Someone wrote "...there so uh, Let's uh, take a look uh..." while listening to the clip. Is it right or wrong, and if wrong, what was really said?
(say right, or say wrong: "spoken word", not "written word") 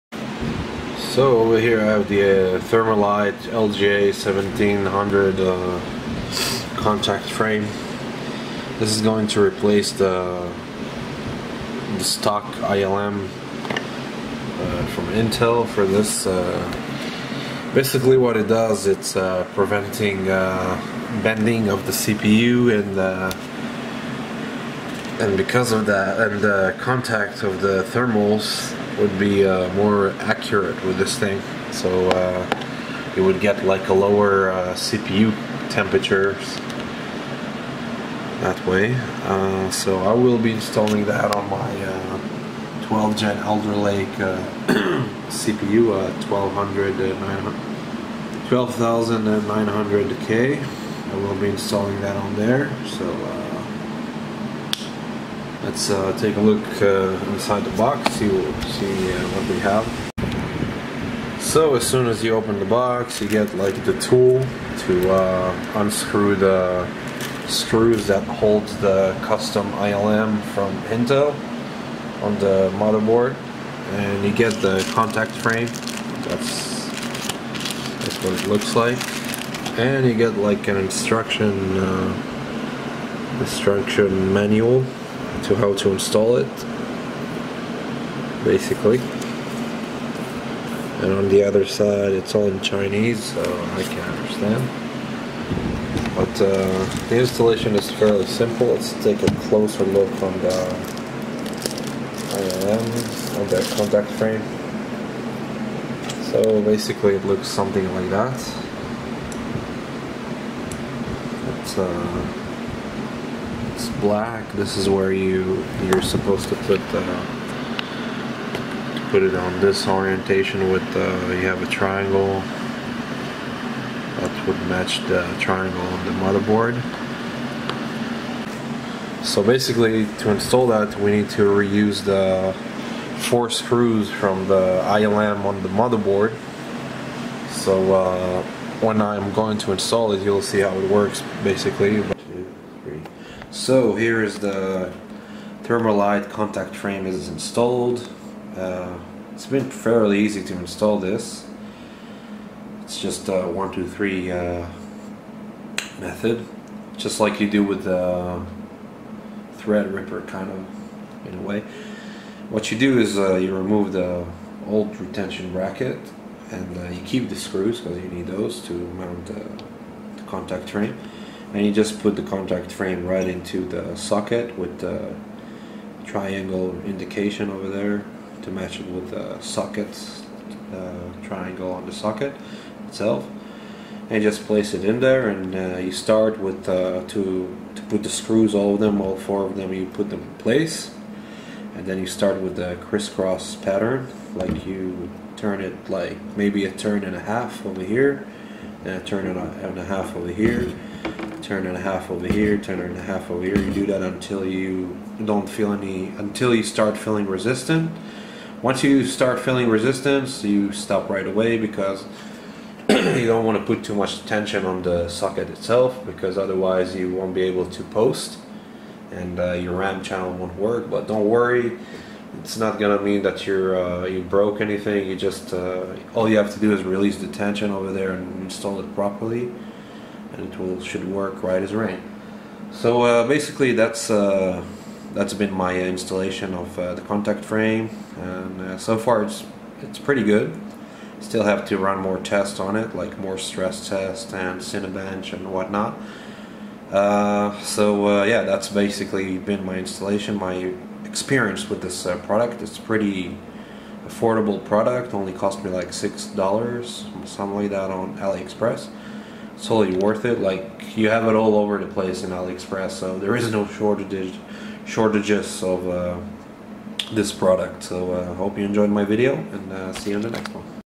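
right.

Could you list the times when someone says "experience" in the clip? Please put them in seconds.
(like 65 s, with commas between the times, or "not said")
251 s.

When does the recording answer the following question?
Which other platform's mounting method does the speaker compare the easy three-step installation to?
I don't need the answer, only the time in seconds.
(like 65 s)
159 s.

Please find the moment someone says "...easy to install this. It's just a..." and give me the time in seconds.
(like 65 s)
150 s.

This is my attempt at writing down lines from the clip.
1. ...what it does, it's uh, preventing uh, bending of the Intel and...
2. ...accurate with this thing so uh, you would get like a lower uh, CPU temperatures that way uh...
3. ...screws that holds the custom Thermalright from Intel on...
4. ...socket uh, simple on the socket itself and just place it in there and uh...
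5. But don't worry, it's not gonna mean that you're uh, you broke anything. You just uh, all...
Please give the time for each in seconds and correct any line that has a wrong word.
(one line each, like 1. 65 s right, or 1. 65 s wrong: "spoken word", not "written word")
1. 18 s wrong: "CPU", not "Intel"
2. 30 s right
3. 67 s wrong: "ILM", not "Thermalright"
4. 179 s wrong: "triangle", not "simple"
5. 220 s right.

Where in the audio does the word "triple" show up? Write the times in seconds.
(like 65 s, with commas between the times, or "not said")
not said.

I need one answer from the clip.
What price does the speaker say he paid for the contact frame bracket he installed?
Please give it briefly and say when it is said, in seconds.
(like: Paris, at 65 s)
$6, at 255 s.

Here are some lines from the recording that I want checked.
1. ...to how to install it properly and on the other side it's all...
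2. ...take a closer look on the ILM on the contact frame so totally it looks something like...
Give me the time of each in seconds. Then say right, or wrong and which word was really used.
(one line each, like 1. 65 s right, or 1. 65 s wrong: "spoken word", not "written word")
1. 85 s wrong: "basically", not "properly"
2. 99 s wrong: "basically", not "totally".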